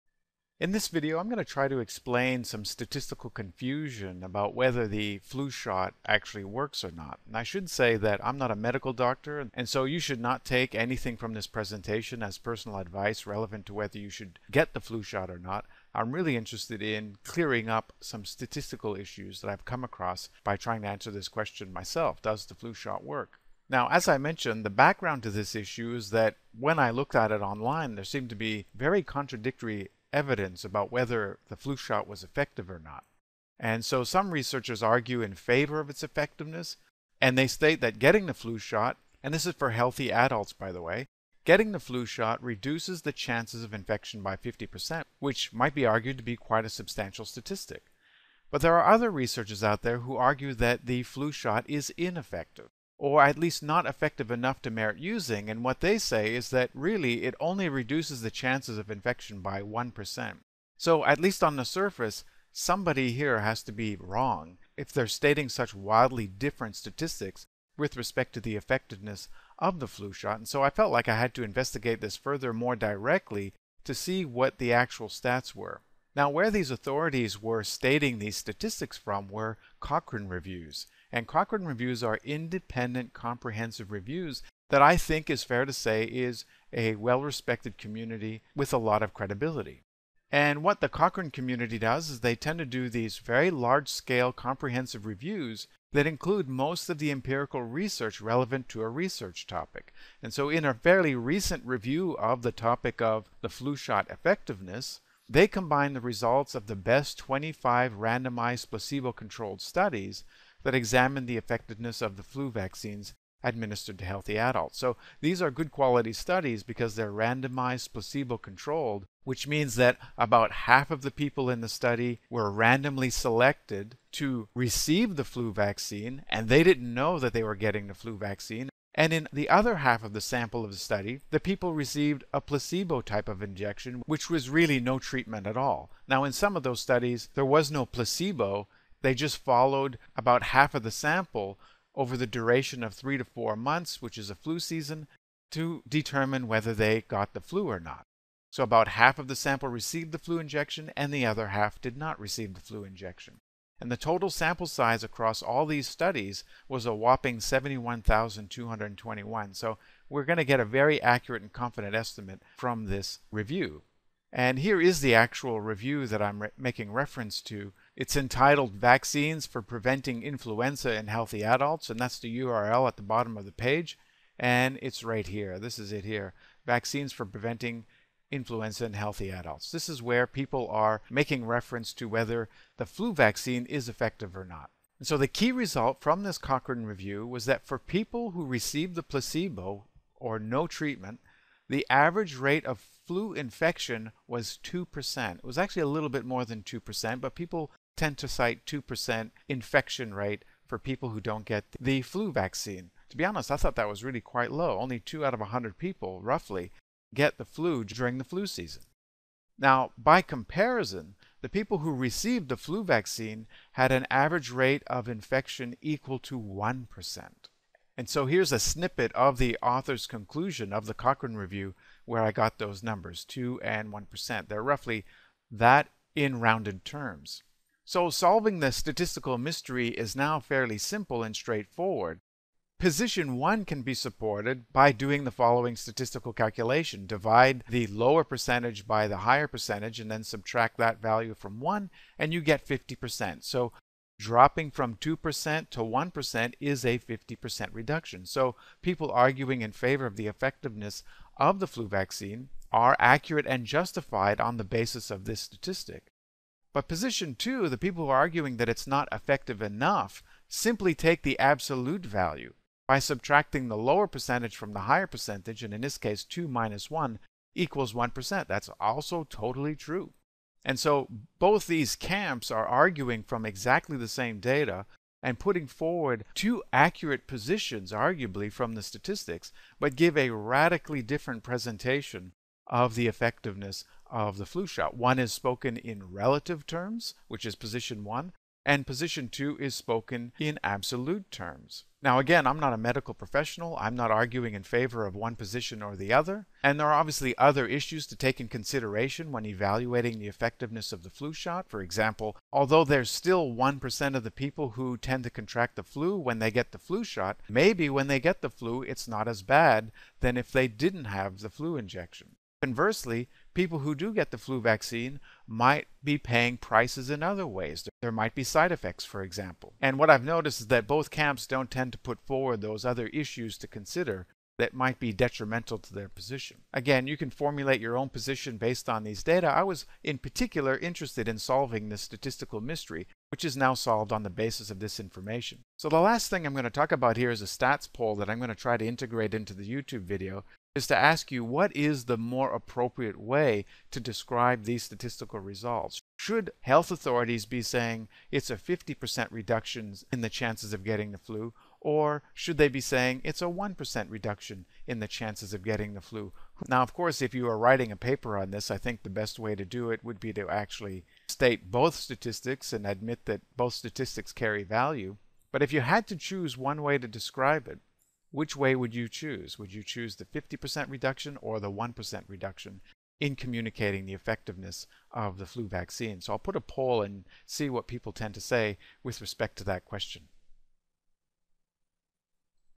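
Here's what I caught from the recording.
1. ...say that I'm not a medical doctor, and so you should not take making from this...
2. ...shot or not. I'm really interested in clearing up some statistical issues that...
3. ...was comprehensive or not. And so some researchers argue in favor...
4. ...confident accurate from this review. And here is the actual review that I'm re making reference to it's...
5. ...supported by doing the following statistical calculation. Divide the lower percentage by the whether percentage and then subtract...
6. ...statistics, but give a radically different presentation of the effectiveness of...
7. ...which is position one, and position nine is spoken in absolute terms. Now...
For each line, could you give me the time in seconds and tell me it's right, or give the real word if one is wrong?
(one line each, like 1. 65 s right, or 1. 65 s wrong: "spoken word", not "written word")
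1. 7 s wrong: "anything", not "making"
2. 15 s right
3. 32 s wrong: "effective", not "comprehensive"
4. 161 s wrong: "estimate", not "accurate"
5. 233 s wrong: "higher", not "whether"
6. 278 s right
7. 287 s wrong: "two", not "nine".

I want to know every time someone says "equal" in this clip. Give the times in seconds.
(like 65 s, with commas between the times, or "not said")
215 s, 267 s.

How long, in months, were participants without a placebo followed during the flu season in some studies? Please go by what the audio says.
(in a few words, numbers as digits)
3 to 4 months.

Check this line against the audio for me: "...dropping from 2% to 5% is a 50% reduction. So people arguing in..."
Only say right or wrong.
wrong.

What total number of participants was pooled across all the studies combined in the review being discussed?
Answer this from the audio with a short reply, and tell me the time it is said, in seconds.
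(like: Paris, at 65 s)
71,221, at 157 s.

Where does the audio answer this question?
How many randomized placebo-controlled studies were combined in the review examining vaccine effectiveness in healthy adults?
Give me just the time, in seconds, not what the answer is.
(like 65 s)
107 s.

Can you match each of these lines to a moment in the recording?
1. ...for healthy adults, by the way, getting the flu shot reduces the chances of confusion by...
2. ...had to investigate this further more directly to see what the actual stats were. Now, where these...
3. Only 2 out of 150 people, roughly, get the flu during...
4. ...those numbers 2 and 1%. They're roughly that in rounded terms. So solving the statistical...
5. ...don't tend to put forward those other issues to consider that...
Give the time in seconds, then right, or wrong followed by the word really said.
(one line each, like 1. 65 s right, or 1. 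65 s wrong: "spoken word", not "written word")
1. 39 s wrong: "infection", not "confusion"
2. 71 s right
3. 204 s wrong: "100", not "150"
4. 222 s right
5. 321 s right.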